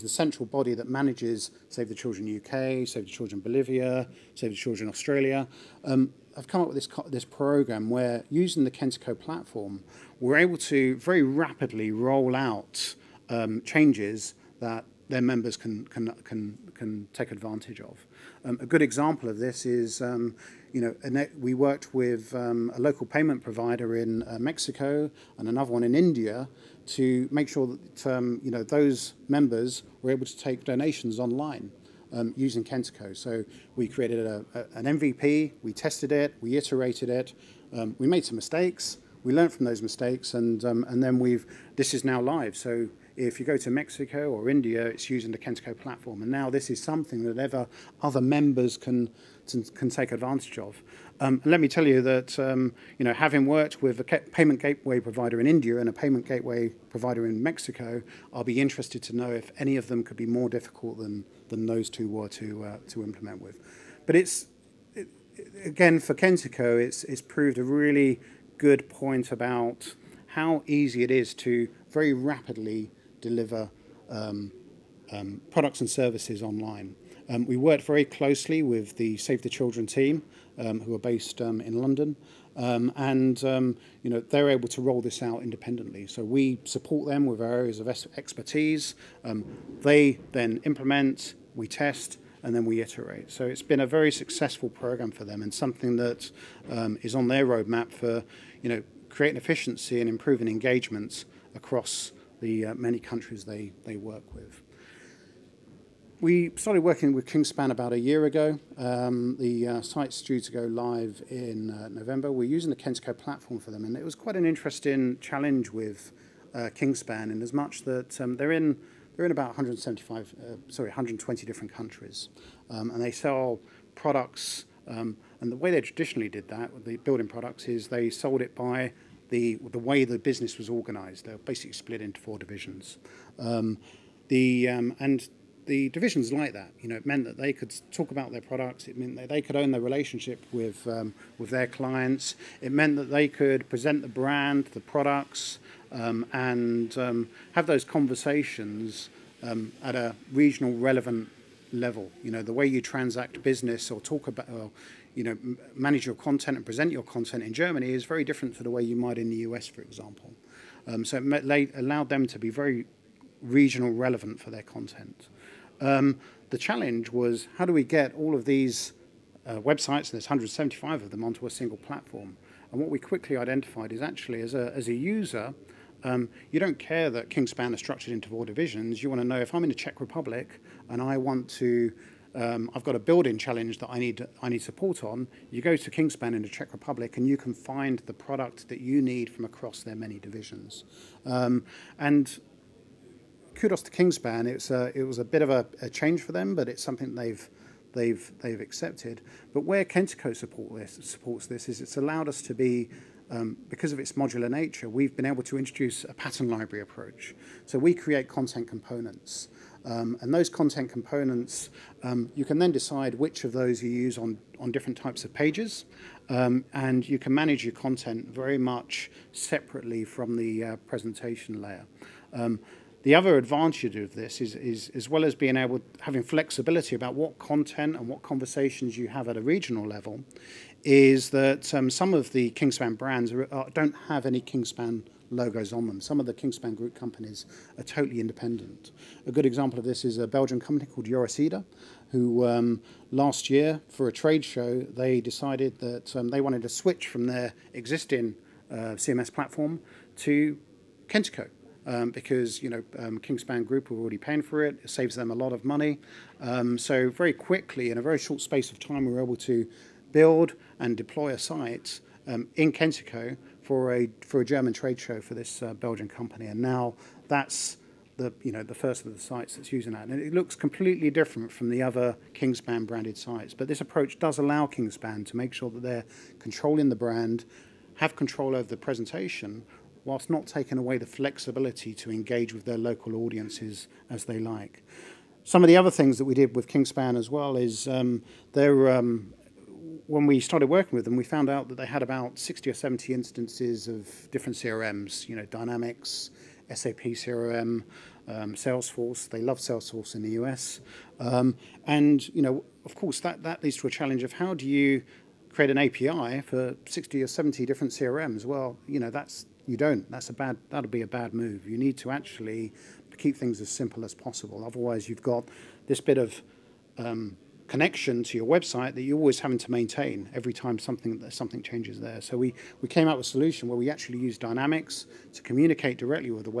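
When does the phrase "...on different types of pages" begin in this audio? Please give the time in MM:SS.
03:34.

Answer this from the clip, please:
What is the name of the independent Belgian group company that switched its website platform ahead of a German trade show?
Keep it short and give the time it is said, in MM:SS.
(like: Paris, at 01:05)
Eurocida, at 04:01.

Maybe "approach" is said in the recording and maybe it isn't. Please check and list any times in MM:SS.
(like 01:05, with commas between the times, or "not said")
03:26, 04:33.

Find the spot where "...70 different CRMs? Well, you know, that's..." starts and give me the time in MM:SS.
05:07.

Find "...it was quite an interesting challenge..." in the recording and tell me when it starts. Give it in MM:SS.
01:53.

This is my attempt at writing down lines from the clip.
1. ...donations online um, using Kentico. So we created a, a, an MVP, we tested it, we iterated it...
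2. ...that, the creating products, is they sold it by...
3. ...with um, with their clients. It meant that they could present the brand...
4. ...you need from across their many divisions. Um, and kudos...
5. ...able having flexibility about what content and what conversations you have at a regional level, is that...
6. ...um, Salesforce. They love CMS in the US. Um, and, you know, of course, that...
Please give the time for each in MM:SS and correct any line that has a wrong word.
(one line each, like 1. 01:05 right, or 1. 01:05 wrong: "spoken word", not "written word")
1. 00:30 right
2. 02:06 wrong: "building", not "creating"
3. 02:20 right
4. 03:08 right
5. 03:45 right
6. 04:58 wrong: "Salesforce", not "CMS".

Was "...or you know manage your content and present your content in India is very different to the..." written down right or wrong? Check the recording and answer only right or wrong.
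wrong.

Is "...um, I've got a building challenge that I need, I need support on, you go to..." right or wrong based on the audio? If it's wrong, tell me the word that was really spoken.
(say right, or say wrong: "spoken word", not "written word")
right.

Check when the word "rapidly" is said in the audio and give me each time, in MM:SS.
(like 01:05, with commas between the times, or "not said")
00:11, 01:12.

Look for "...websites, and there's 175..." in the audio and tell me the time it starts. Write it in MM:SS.
02:49.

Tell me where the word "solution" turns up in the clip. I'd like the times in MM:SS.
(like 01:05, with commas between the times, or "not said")
05:23.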